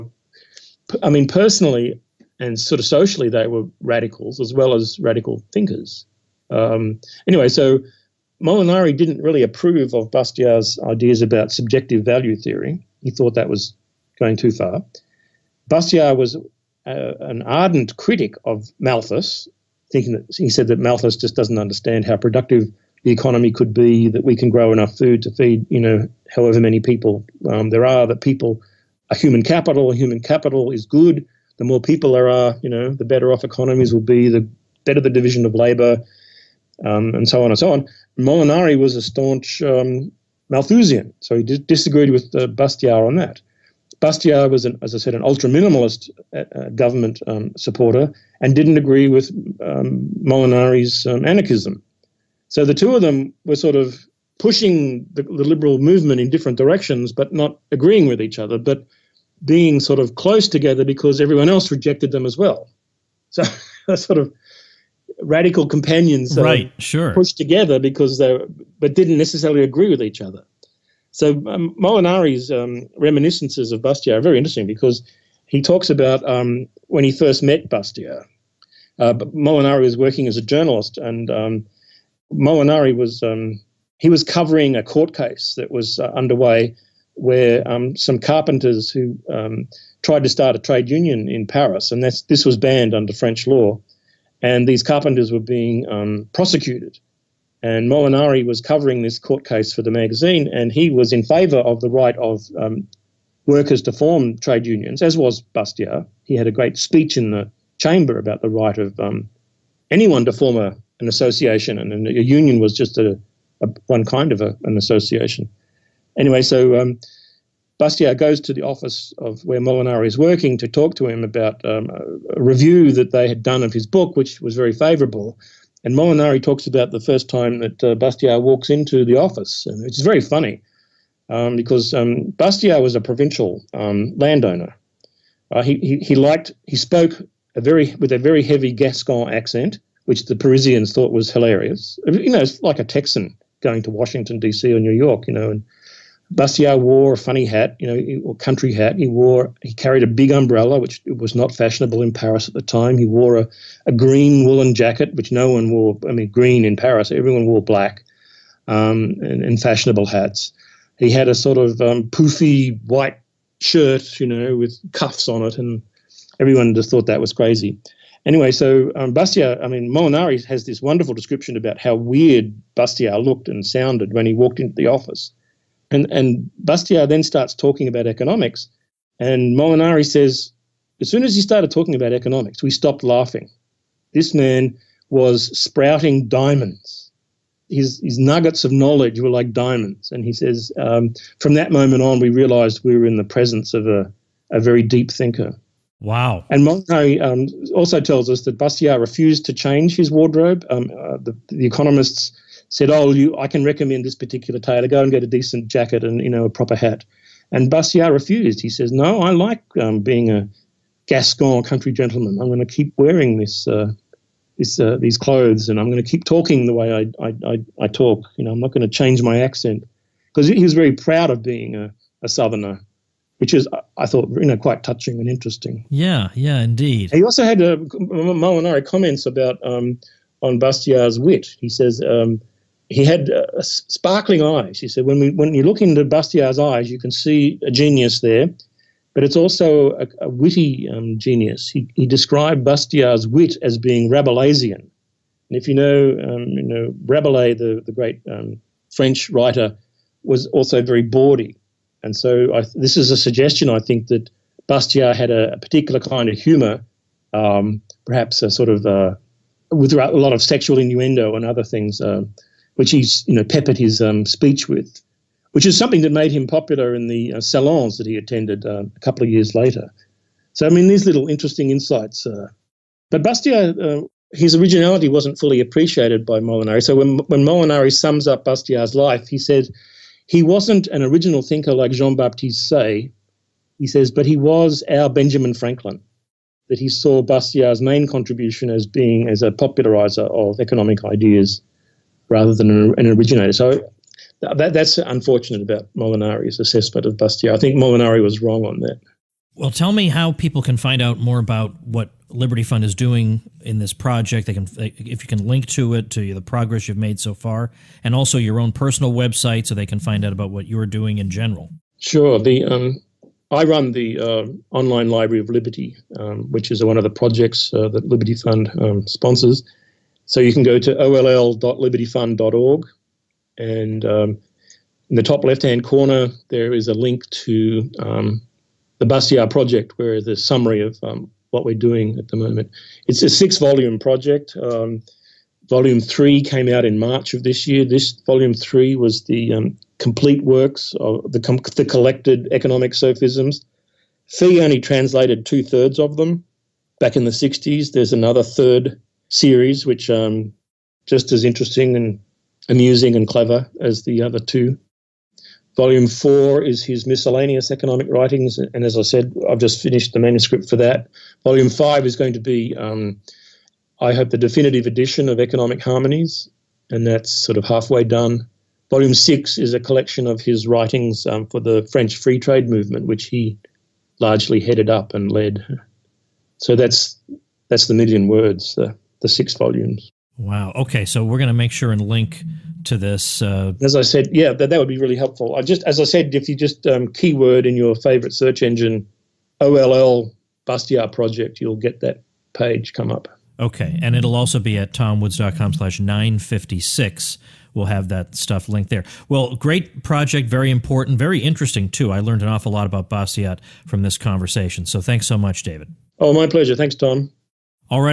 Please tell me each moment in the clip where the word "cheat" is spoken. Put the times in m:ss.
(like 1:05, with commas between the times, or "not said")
not said.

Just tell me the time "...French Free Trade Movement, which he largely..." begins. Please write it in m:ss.
6:11.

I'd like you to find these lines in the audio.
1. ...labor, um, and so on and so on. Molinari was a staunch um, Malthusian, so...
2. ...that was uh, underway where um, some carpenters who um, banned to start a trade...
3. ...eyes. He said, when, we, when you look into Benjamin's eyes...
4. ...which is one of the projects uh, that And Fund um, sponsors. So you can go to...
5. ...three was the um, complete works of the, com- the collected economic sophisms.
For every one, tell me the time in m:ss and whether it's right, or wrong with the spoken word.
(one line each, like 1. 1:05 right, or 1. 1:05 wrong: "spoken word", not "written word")
1. 0:35 right
2. 1:25 wrong: "tried", not "banned"
3. 3:54 wrong: "Bastiat", not "Benjamin"
4. 5:16 wrong: "Liberty", not "And"
5. 5:38 right.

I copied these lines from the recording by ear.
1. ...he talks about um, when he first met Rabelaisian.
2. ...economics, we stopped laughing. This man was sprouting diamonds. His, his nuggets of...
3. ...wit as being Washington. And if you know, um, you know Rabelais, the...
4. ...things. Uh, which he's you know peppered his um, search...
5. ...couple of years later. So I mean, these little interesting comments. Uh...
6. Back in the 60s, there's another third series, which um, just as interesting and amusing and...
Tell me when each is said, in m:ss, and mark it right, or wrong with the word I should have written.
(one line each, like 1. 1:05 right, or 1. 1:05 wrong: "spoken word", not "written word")
1. 1:15 wrong: "Bastiat", not "Rabelaisian"
2. 3:02 right
3. 4:03 wrong: "Rabelaisian", not "Washington"
4. 4:21 wrong: "speech", not "search"
5. 4:28 wrong: "insights", not "comments"
6. 5:46 right.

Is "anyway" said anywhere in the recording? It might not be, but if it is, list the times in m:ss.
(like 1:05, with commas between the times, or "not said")
0:07, 1:56, 2:48.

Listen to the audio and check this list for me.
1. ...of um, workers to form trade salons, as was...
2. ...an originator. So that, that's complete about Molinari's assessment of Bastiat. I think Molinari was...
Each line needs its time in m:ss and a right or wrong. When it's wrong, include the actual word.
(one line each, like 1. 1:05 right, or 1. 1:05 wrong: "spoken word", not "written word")
1. 1:42 wrong: "unions", not "salons"
2. 4:52 wrong: "unfortunate", not "complete".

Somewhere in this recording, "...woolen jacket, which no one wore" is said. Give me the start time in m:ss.
2:34.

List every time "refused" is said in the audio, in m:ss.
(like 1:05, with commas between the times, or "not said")
3:18, 3:28.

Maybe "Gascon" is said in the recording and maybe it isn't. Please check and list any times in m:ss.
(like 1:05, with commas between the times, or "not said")
2:18, 3:31.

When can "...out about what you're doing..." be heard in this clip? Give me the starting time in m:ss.
5:10.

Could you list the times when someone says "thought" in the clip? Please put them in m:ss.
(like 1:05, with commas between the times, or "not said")
0:13, 2:20, 2:46, 3:44.